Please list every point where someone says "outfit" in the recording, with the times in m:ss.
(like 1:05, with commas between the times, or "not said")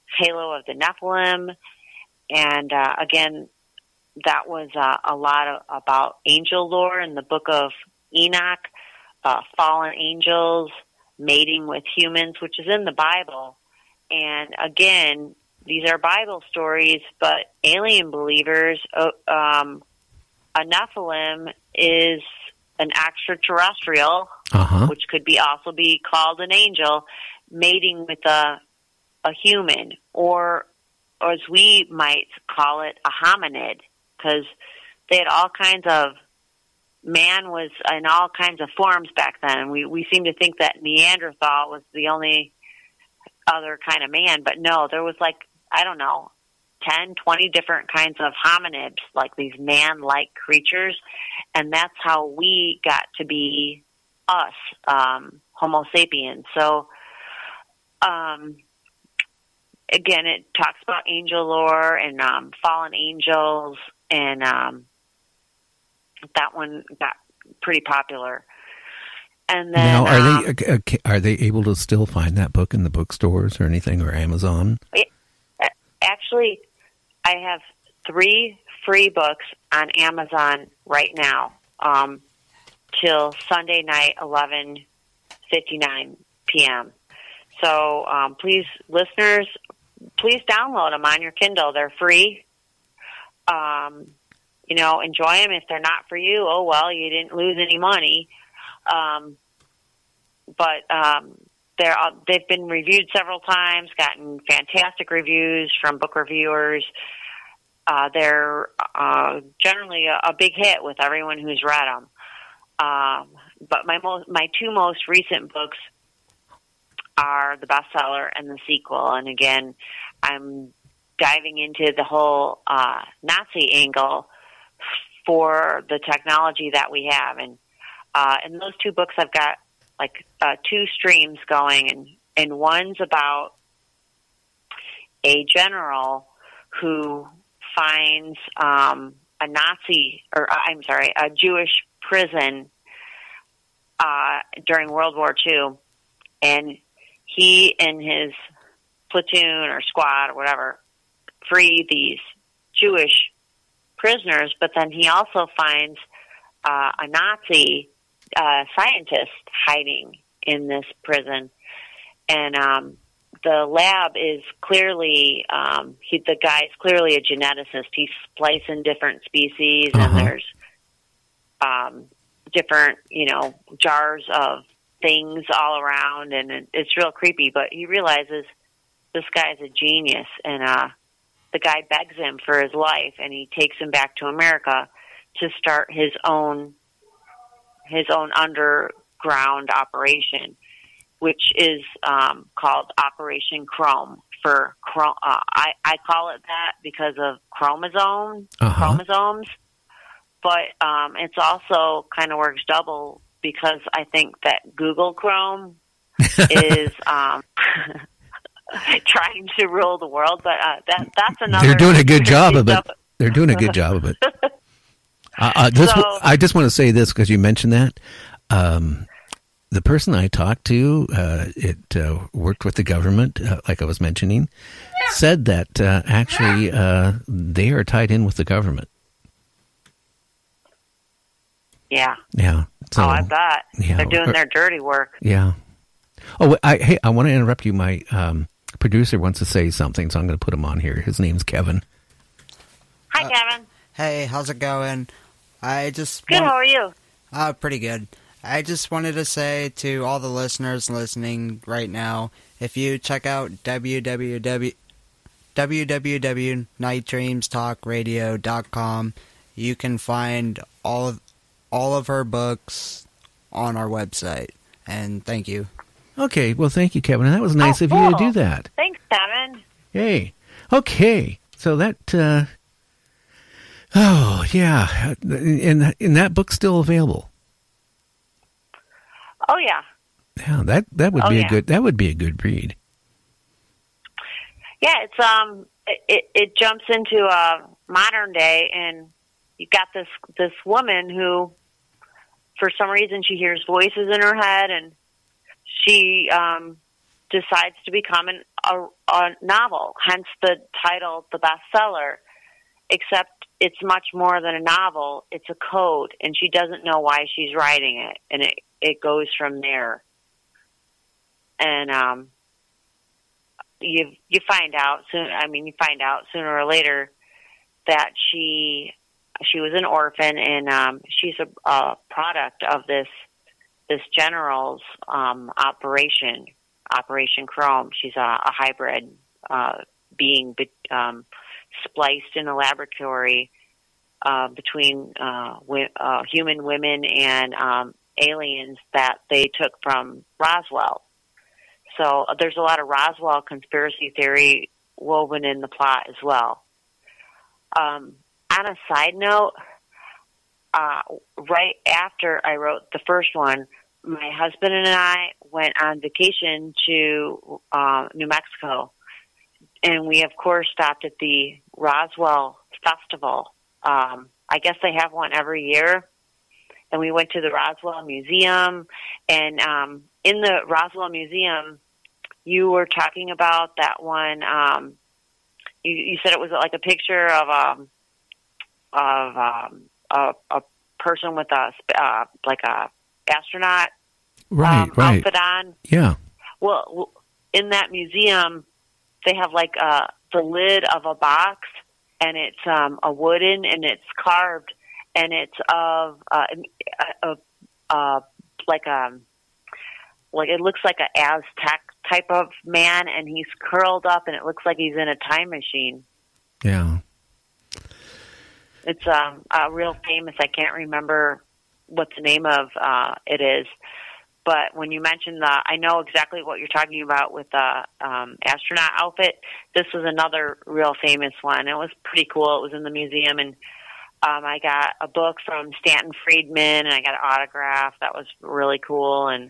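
6:25, 6:58.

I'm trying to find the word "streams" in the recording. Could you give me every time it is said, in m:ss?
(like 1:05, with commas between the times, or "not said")
2:10.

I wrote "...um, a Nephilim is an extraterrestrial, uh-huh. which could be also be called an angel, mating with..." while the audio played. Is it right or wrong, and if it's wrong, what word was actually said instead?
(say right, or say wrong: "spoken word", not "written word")
right.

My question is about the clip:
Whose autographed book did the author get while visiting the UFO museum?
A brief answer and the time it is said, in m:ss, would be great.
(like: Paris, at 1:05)
Stanton Friedman, at 7:05.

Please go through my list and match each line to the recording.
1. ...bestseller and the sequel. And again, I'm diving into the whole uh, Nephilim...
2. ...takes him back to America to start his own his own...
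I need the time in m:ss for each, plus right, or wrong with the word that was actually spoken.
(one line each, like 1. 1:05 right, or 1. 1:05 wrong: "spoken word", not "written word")
1. 1:57 wrong: "Nazi", not "Nephilim"
2. 3:03 right.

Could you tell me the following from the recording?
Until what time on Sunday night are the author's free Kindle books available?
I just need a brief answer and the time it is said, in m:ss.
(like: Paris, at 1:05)
11:59 p.m., at 1:24.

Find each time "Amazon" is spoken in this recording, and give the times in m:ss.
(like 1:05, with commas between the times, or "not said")
1:14, 1:19.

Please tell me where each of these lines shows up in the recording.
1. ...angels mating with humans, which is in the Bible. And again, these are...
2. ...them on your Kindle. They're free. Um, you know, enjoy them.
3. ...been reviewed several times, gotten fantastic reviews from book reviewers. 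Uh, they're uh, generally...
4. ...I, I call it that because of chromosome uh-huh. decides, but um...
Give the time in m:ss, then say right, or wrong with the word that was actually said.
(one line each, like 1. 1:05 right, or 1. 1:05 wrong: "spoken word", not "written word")
1. 0:09 right
2. 1:30 right
3. 1:42 right
4. 3:15 wrong: "chromosomes", not "decides".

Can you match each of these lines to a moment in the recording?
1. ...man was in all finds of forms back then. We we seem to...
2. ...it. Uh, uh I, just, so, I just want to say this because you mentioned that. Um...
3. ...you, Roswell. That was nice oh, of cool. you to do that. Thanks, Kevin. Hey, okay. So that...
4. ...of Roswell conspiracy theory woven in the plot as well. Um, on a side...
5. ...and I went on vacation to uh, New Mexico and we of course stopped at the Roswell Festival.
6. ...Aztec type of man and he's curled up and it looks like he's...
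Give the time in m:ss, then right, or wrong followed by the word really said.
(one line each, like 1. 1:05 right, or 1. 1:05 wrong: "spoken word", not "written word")
1. 0:37 wrong: "kinds", not "finds"
2. 3:34 right
3. 4:26 wrong: "Kevin", not "Roswell"
4. 5:42 right
5. 5:54 right
6. 6:41 right.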